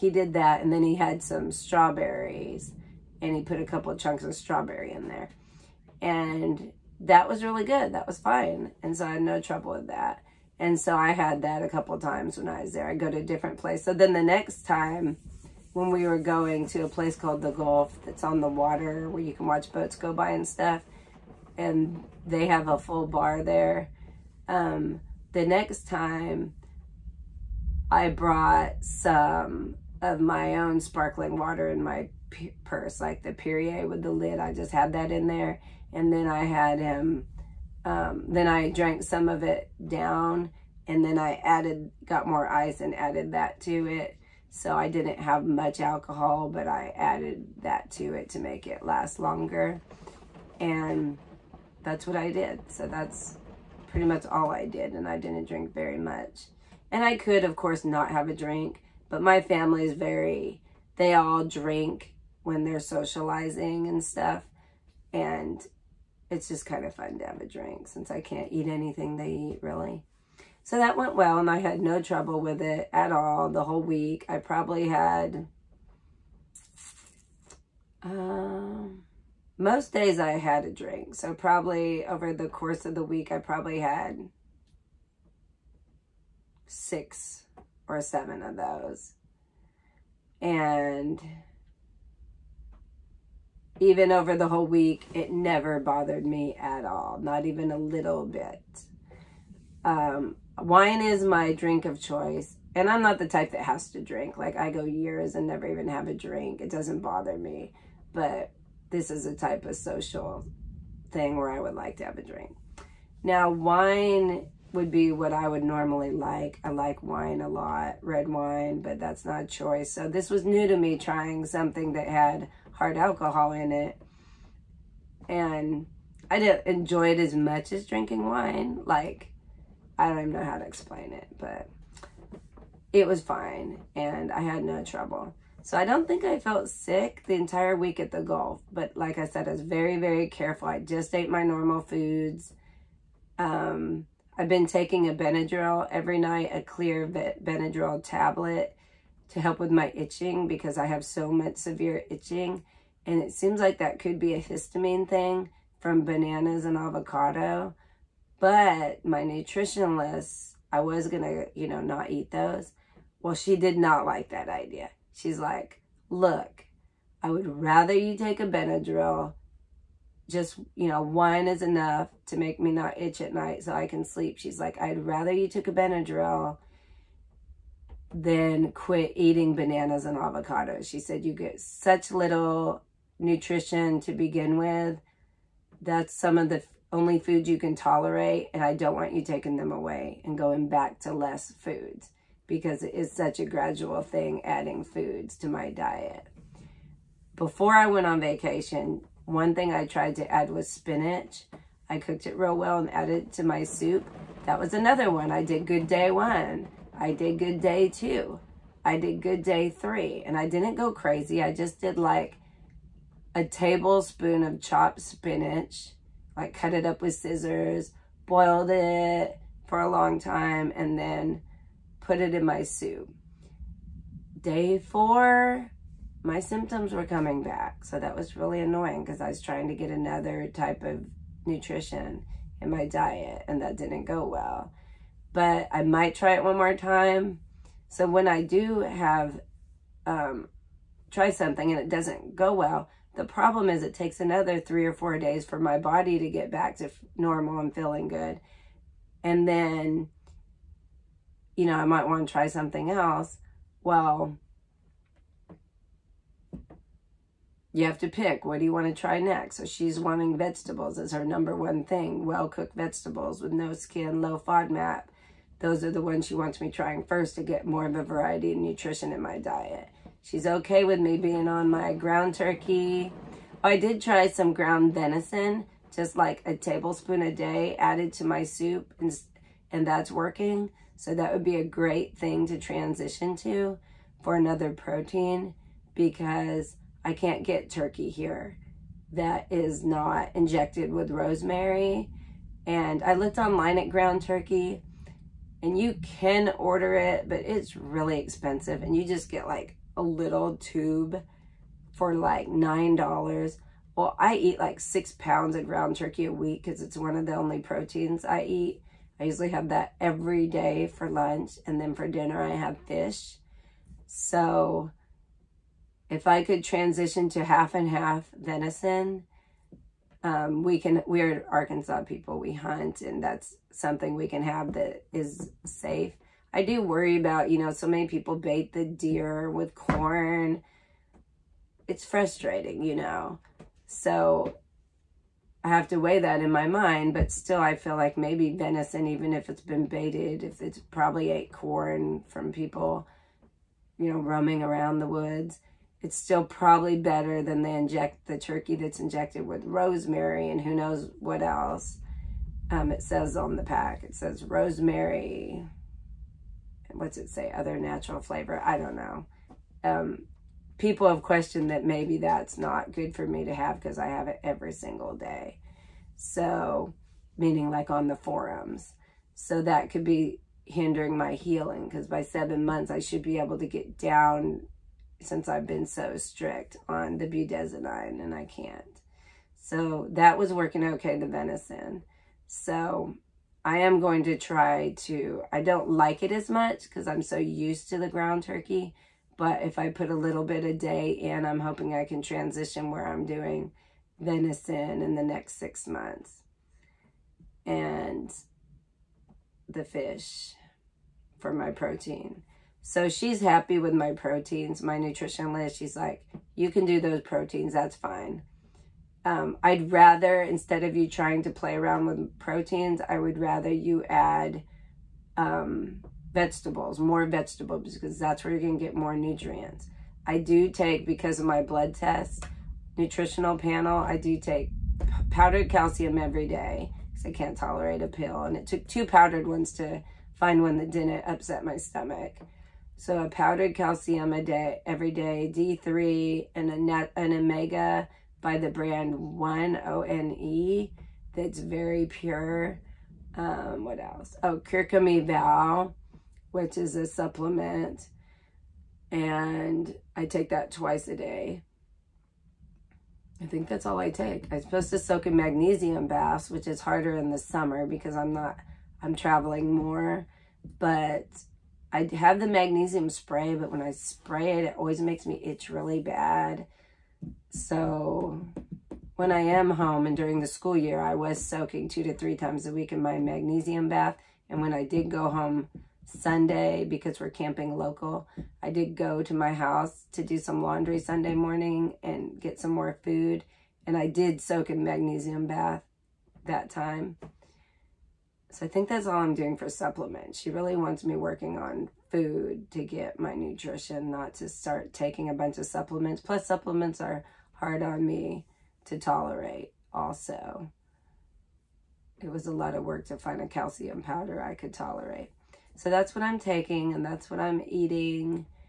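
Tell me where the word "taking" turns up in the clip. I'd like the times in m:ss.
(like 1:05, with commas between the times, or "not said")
2:24, 3:09, 8:14, 8:26.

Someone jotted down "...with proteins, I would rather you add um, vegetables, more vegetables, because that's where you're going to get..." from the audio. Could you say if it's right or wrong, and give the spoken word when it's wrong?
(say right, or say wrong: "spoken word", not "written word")
right.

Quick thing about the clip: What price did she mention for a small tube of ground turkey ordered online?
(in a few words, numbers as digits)
$9.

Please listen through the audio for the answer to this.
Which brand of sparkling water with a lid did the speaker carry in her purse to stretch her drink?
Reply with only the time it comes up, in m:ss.
0:33.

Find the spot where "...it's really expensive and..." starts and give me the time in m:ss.
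4:57.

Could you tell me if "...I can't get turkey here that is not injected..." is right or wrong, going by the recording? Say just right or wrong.
right.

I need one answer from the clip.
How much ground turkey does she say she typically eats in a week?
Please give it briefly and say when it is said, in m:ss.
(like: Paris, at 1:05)
6 pounds, at 5:04.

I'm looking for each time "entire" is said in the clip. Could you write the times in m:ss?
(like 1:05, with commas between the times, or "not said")
2:17.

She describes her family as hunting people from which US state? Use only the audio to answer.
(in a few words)
Arkansas.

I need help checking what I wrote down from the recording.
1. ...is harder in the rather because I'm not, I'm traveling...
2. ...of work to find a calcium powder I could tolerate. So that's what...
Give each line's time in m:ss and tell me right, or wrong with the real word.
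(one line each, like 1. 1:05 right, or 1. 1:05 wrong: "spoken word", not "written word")
1. 7:36 wrong: "summer", not "rather"
2. 8:22 right.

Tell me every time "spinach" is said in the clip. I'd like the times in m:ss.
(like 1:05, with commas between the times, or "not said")
3:20, 3:35.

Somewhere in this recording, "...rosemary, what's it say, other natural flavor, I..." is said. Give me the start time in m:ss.
5:54.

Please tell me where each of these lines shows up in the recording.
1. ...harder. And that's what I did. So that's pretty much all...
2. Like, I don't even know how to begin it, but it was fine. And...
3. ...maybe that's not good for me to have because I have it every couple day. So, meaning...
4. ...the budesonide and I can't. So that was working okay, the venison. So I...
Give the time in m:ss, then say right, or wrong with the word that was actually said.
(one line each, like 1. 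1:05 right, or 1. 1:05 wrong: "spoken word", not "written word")
1. 0:49 wrong: "longer", not "harder"
2. 2:08 wrong: "explain", not "begin"
3. 6:01 wrong: "single", not "couple"
4. 6:17 right.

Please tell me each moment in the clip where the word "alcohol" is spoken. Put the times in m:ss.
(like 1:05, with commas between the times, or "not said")
0:45, 2:02.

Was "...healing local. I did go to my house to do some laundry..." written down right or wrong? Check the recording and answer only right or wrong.
wrong.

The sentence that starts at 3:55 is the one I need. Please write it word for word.
But I might try it one more time.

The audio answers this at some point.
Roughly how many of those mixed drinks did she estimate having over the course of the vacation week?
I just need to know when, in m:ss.
1:26.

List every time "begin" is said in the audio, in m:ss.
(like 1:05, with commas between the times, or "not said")
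3:04.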